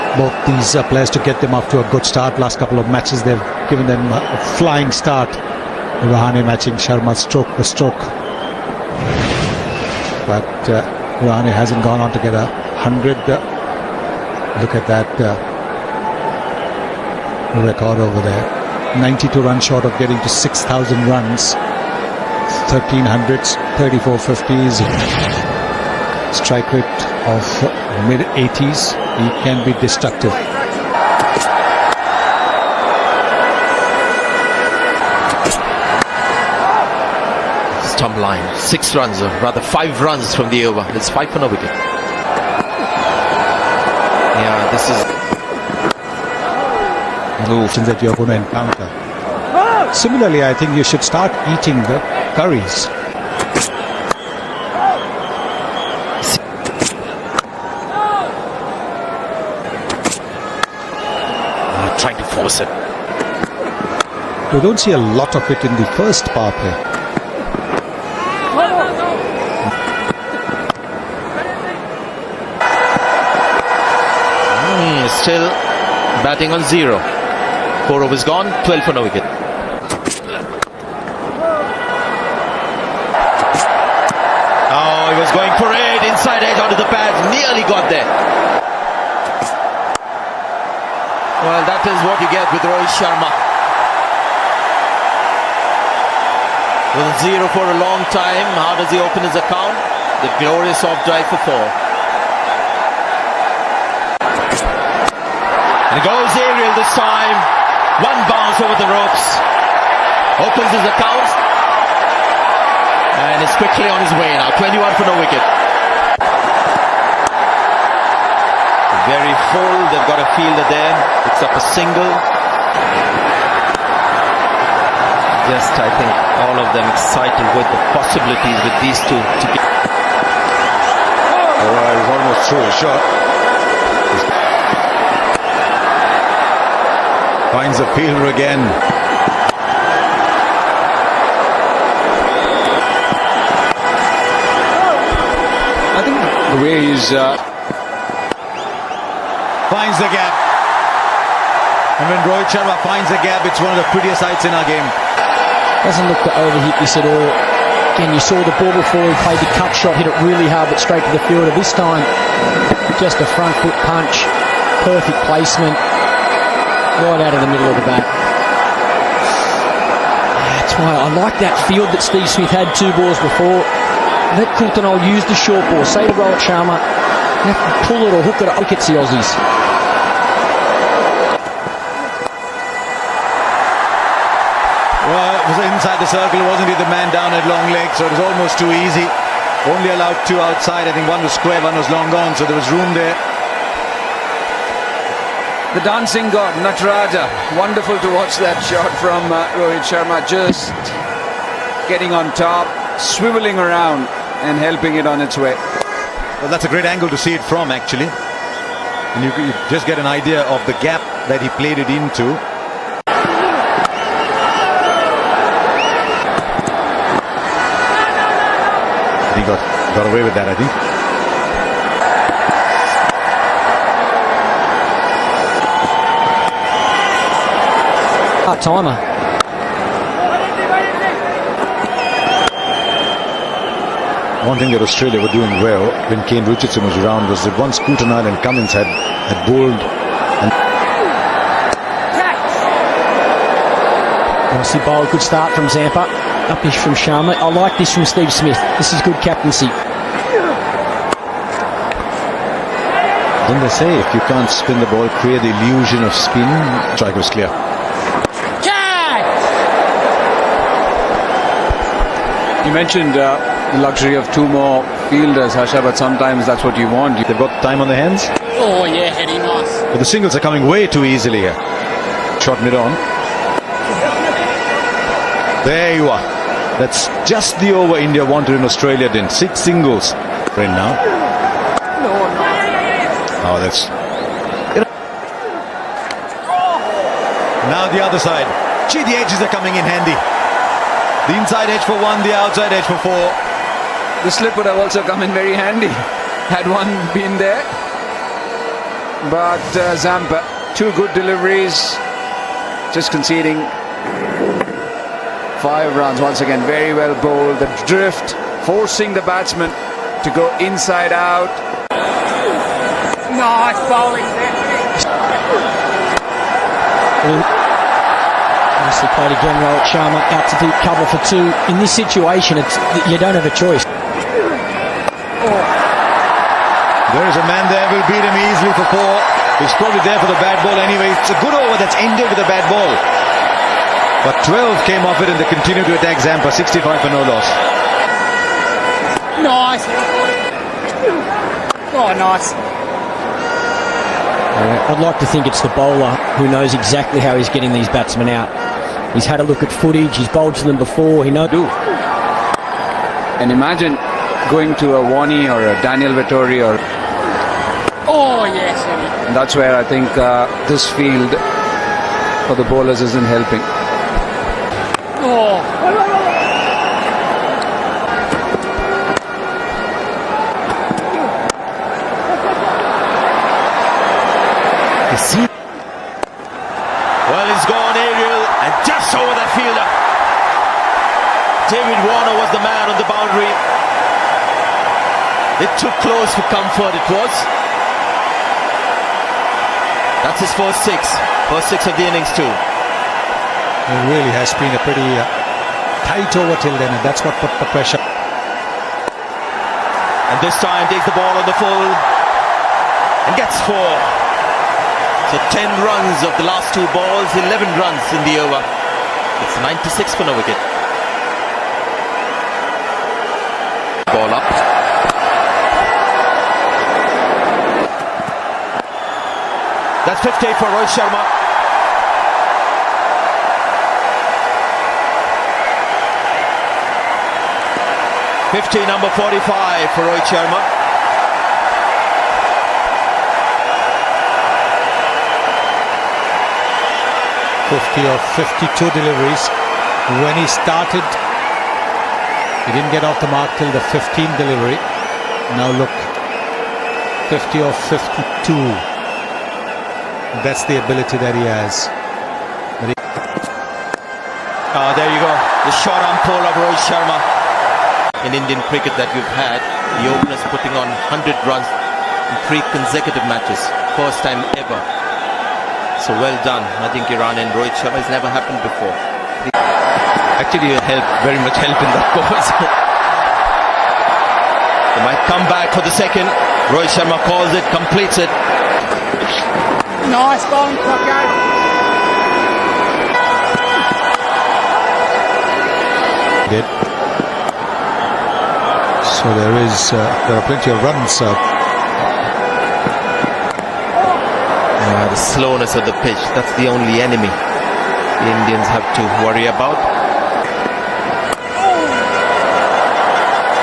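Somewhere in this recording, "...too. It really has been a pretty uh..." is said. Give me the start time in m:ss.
6:32.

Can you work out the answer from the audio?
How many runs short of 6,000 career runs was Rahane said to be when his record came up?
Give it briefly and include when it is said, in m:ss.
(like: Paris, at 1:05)
92, at 0:19.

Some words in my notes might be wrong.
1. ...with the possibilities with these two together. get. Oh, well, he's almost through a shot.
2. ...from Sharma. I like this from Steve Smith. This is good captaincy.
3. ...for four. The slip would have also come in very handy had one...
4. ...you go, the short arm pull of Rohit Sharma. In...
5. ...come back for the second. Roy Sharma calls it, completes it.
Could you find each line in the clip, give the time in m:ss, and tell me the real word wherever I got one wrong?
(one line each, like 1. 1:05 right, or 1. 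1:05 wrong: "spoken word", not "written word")
1. 2:07 right
2. 4:06 right
3. 4:52 right
4. 7:35 right
5. 7:55 right.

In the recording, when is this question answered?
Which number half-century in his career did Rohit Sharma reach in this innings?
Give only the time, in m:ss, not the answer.
7:09.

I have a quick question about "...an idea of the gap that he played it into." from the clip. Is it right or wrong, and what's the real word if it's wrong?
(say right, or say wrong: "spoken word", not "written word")
right.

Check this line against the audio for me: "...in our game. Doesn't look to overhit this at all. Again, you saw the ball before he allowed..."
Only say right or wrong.
wrong.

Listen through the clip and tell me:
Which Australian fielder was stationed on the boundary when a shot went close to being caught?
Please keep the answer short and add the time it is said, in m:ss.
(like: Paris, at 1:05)
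David Warner, at 6:21.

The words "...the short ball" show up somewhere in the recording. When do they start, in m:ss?
2:55.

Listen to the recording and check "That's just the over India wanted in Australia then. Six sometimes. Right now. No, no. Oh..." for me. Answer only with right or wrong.
wrong.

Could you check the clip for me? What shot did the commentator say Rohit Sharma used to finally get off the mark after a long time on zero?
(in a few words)
off drive.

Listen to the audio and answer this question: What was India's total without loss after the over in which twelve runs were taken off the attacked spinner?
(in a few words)
65.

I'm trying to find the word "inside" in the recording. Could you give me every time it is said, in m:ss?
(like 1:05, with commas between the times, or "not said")
1:26, 3:05, 4:51, 5:10.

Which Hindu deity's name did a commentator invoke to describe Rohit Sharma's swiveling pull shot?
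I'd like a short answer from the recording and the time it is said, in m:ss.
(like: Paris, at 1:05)
Nataraja, at 3:16.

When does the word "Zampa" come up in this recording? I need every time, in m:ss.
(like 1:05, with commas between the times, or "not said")
4:05, 4:59, 5:36.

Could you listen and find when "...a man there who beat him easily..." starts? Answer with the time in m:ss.
5:27.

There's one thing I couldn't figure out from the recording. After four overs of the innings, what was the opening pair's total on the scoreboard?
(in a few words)
12 for no wicket.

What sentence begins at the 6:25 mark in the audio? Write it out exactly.
It took close for comfort, it was.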